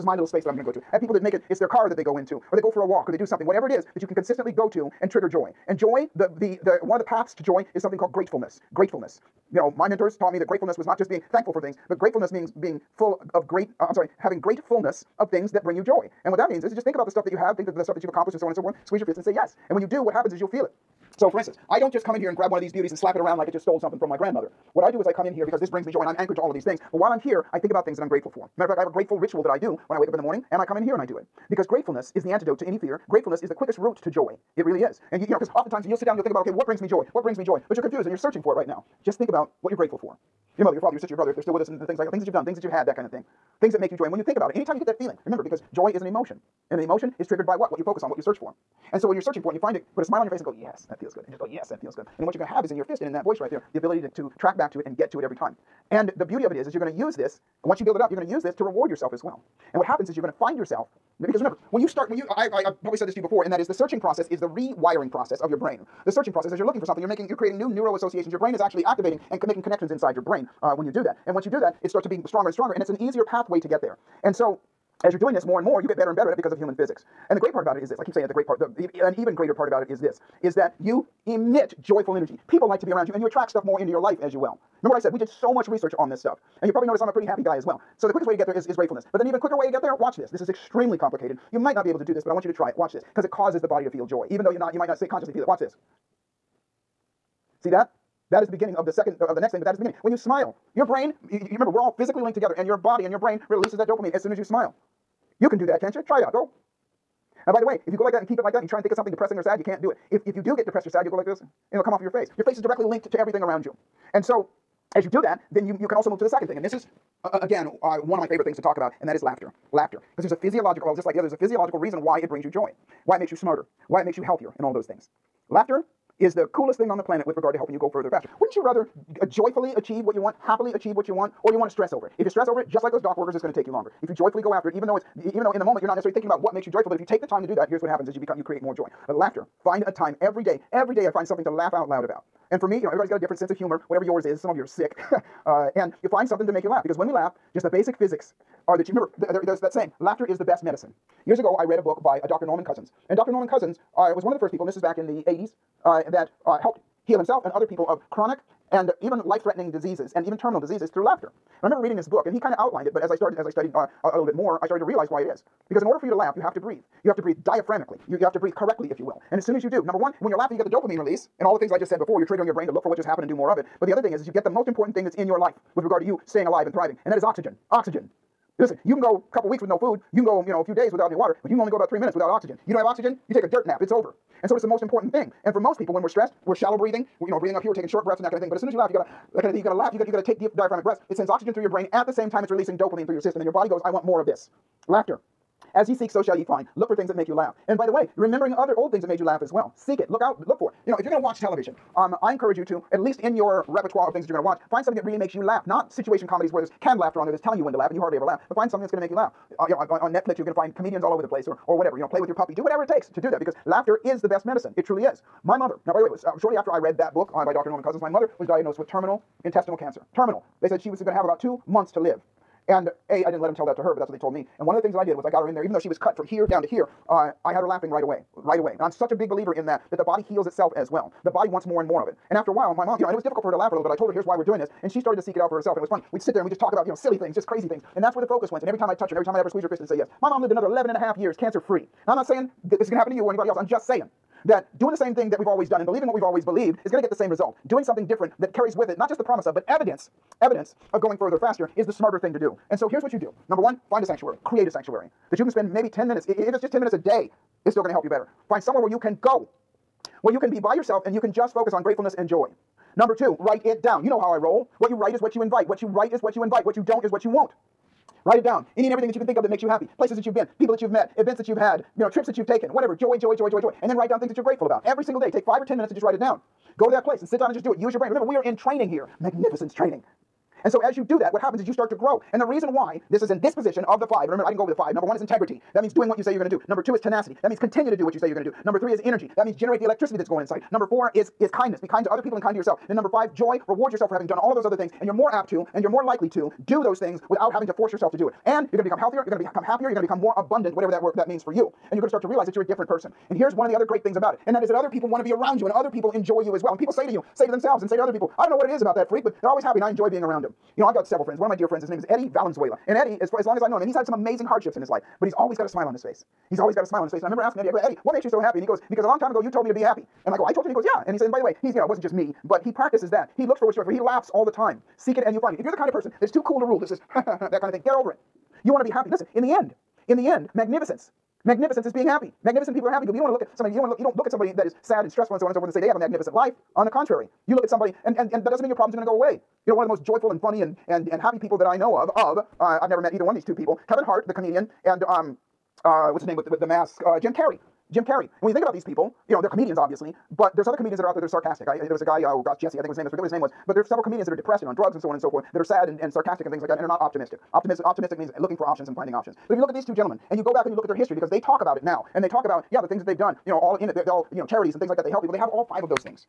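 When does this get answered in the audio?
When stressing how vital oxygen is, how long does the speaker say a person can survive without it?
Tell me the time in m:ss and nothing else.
3:01.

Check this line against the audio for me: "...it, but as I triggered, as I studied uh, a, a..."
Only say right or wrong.
wrong.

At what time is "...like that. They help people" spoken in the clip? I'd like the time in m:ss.
6:04.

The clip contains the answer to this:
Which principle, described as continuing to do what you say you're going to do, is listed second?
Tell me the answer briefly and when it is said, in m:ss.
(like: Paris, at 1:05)
Tenacity, at 4:47.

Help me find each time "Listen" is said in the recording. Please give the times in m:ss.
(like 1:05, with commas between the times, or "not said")
2:58, 5:29.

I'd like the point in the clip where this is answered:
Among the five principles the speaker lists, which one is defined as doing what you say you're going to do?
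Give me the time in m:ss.
4:45.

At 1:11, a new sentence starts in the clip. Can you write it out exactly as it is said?
And once you do that, it starts to be stronger and stronger, and it's an easier pathway to get there.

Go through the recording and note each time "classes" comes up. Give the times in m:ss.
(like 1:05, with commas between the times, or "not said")
not said.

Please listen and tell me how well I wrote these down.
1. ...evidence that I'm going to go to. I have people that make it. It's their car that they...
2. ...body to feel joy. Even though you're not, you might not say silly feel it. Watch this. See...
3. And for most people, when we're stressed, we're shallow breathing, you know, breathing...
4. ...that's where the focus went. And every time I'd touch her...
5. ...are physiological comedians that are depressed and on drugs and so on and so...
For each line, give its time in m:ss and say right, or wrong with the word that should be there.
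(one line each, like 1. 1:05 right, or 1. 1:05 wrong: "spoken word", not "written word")
1. 0:00 wrong: "space", not "evidence"
2. 1:33 wrong: "consciously", not "silly"
3. 3:05 right
4. 3:58 right
5. 5:53 wrong: "several", not "physiological".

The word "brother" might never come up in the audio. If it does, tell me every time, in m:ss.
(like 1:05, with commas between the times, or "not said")
0:41.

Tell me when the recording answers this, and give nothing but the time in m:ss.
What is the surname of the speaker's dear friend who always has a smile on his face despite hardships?
5:12.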